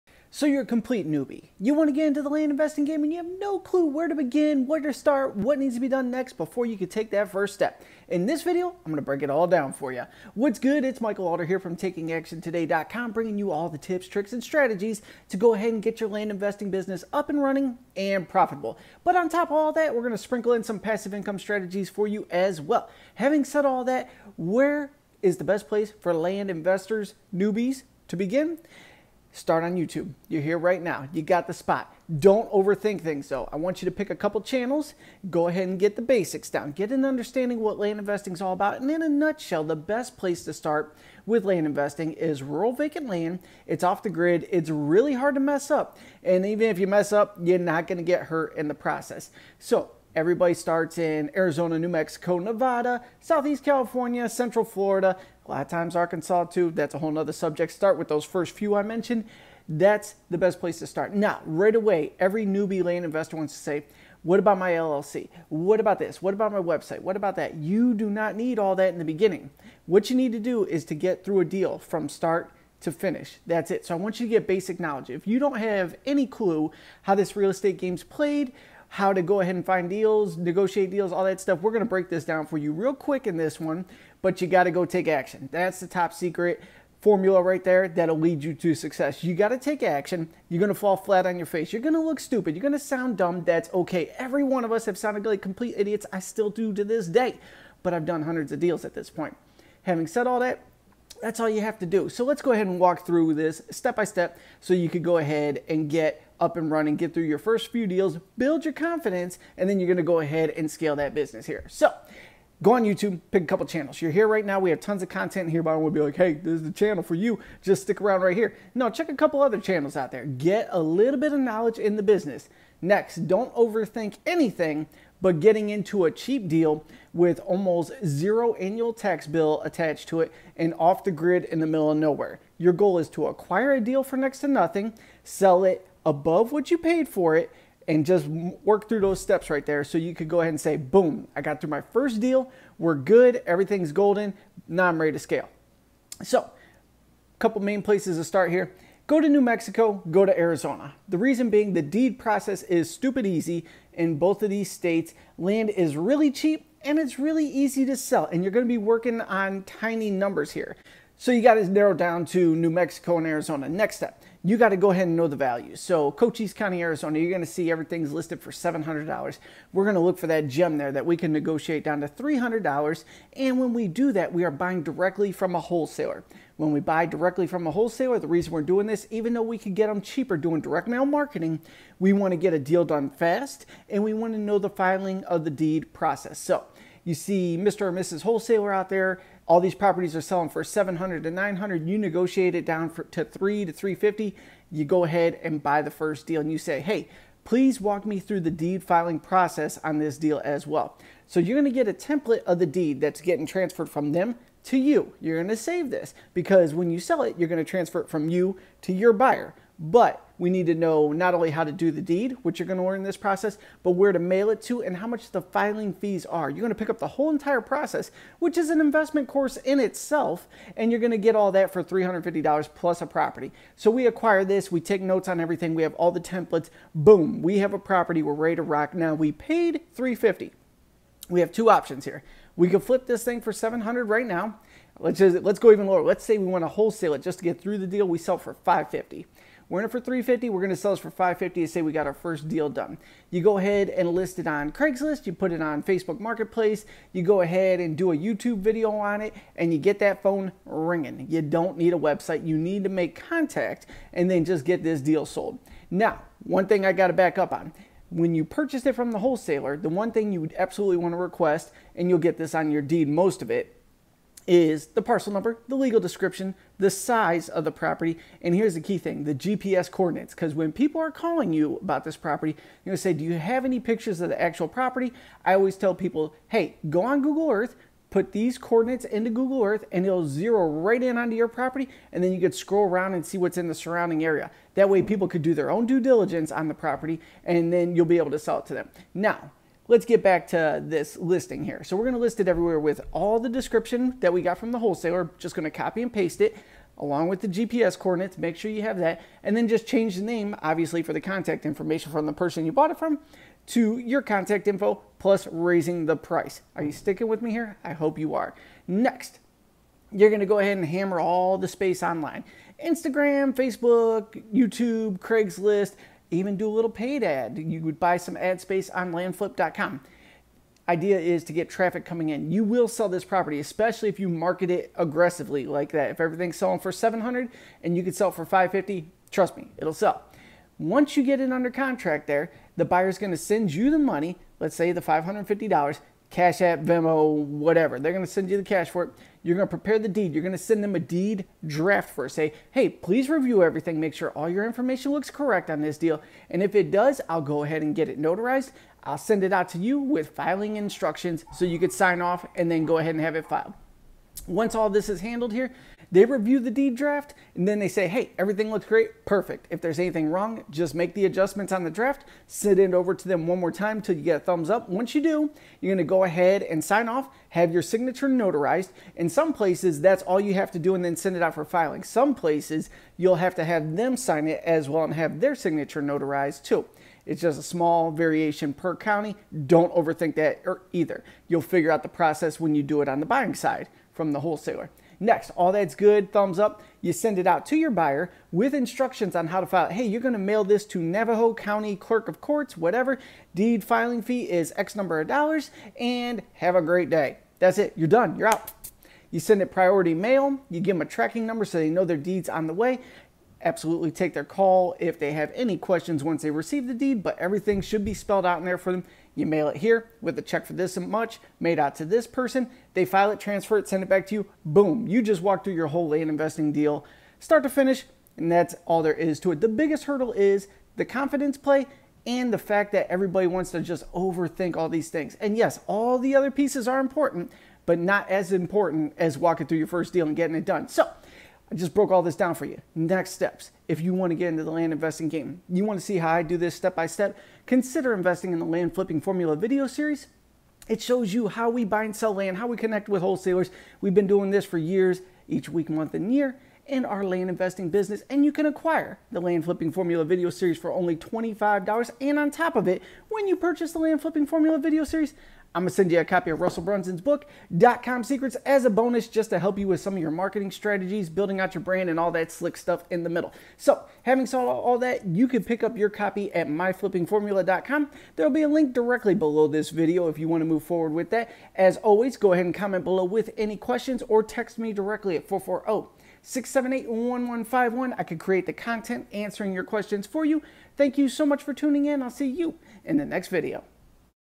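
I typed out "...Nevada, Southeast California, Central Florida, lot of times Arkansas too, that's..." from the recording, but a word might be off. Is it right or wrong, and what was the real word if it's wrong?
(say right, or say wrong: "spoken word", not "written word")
right.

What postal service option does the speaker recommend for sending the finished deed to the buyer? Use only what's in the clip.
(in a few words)
Priority mail.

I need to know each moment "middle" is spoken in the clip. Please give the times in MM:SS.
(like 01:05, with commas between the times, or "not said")
02:11, 07:43.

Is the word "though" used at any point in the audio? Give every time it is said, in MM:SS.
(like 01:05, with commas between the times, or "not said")
00:33, 02:59.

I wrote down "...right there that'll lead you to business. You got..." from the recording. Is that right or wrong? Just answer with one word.
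wrong.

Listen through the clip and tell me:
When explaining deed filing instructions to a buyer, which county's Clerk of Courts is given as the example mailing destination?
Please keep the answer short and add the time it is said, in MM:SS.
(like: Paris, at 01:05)
Navajo County, at 06:31.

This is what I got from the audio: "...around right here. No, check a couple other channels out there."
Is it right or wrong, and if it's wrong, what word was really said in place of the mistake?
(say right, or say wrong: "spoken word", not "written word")
right.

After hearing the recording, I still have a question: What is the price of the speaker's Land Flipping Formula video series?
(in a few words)
$25.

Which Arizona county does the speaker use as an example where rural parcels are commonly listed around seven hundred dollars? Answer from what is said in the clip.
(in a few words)
Cochise County.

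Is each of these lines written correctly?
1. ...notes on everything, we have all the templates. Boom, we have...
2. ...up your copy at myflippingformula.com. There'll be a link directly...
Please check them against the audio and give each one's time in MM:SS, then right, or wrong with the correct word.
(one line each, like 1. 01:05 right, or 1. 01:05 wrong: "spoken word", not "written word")
1. 03:45 right
2. 07:45 right.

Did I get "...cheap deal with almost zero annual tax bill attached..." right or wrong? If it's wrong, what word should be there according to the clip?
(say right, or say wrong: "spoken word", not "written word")
right.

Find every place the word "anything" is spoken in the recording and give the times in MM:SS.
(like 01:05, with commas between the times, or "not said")
02:04, 05:59.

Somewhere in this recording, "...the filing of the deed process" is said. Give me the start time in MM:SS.
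03:04.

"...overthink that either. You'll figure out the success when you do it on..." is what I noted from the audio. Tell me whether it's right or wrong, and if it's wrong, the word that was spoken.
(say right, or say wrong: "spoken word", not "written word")
wrong: "process", not "success".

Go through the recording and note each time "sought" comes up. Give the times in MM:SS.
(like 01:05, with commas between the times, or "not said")
not said.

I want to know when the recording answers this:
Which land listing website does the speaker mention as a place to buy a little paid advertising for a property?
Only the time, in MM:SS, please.
05:19.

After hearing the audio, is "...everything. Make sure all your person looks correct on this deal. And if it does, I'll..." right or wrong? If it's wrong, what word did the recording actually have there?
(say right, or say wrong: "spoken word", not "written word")
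wrong: "information", not "person".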